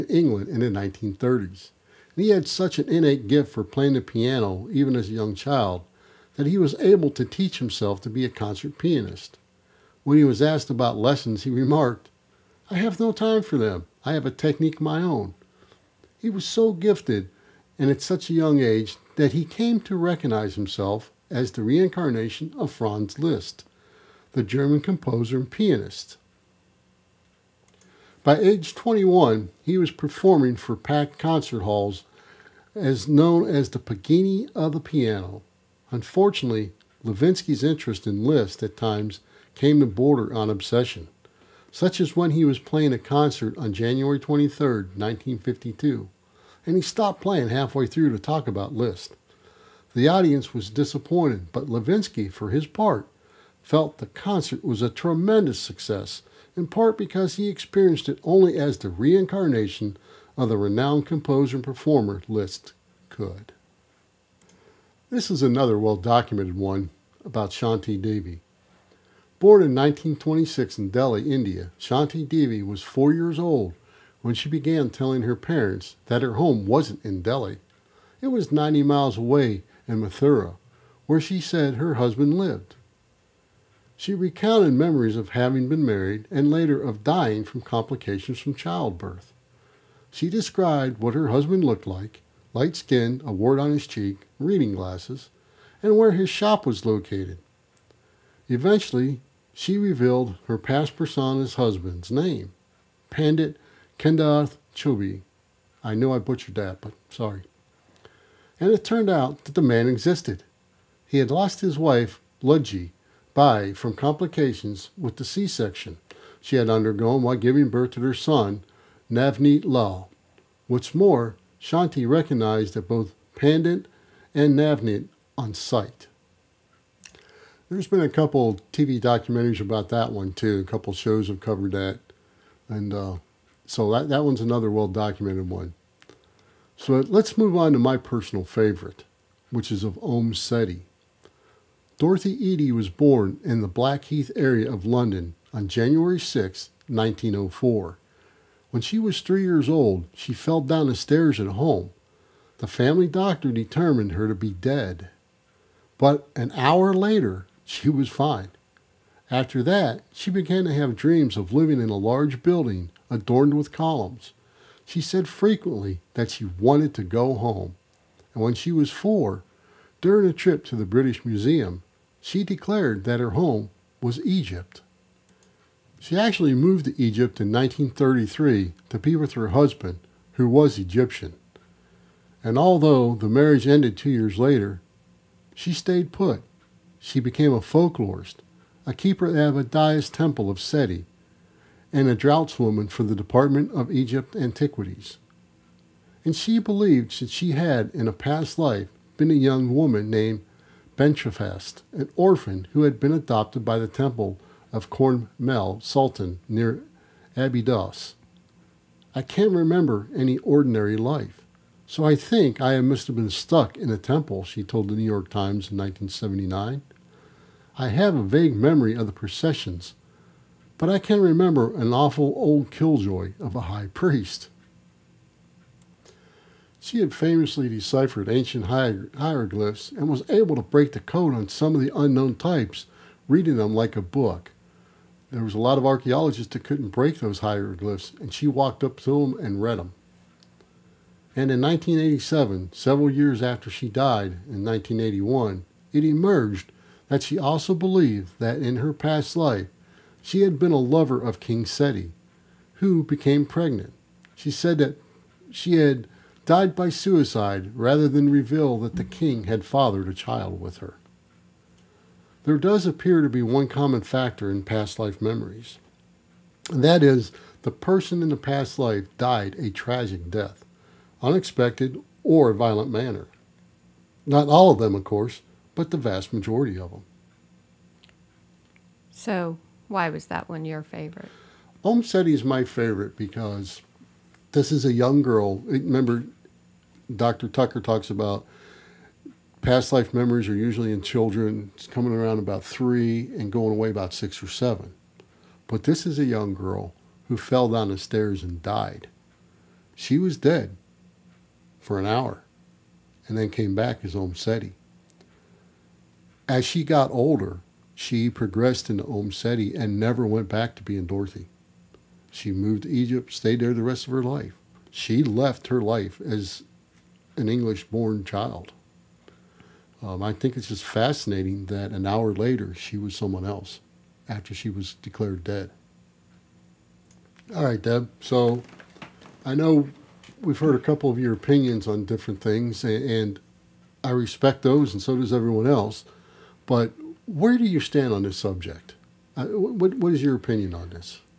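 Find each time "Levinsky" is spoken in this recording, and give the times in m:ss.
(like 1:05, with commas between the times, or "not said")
0:37, 0:51.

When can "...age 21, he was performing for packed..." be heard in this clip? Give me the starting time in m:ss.
0:28.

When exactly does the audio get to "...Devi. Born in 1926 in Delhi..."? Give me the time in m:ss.
1:08.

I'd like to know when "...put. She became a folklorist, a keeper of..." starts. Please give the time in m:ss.
3:06.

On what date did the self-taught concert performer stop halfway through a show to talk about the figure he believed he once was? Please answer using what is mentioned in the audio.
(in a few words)
January 23, 1952.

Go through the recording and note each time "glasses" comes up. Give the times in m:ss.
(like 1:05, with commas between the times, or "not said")
1:34.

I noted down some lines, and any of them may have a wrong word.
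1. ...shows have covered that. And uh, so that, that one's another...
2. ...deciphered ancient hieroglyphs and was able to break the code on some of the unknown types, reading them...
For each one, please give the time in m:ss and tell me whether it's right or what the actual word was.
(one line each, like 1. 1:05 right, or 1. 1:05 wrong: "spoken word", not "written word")
1. 2:10 right
2. 3:47 right.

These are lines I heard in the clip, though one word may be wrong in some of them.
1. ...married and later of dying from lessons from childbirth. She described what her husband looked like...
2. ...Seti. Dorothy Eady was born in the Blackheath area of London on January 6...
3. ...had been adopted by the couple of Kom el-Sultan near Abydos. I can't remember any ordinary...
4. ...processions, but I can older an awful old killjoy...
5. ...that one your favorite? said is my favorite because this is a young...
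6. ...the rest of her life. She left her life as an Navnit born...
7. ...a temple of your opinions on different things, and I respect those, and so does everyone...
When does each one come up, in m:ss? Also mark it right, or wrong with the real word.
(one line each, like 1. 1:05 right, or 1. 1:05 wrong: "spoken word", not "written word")
1. 1:25 wrong: "complications", not "lessons"
2. 2:20 right
3. 3:22 wrong: "temple", not "couple"
4. 3:39 wrong: "remember", not "older"
5. 4:40 right
6. 5:13 wrong: "English", not "Navnit"
7. 5:30 wrong: "couple", not "temple".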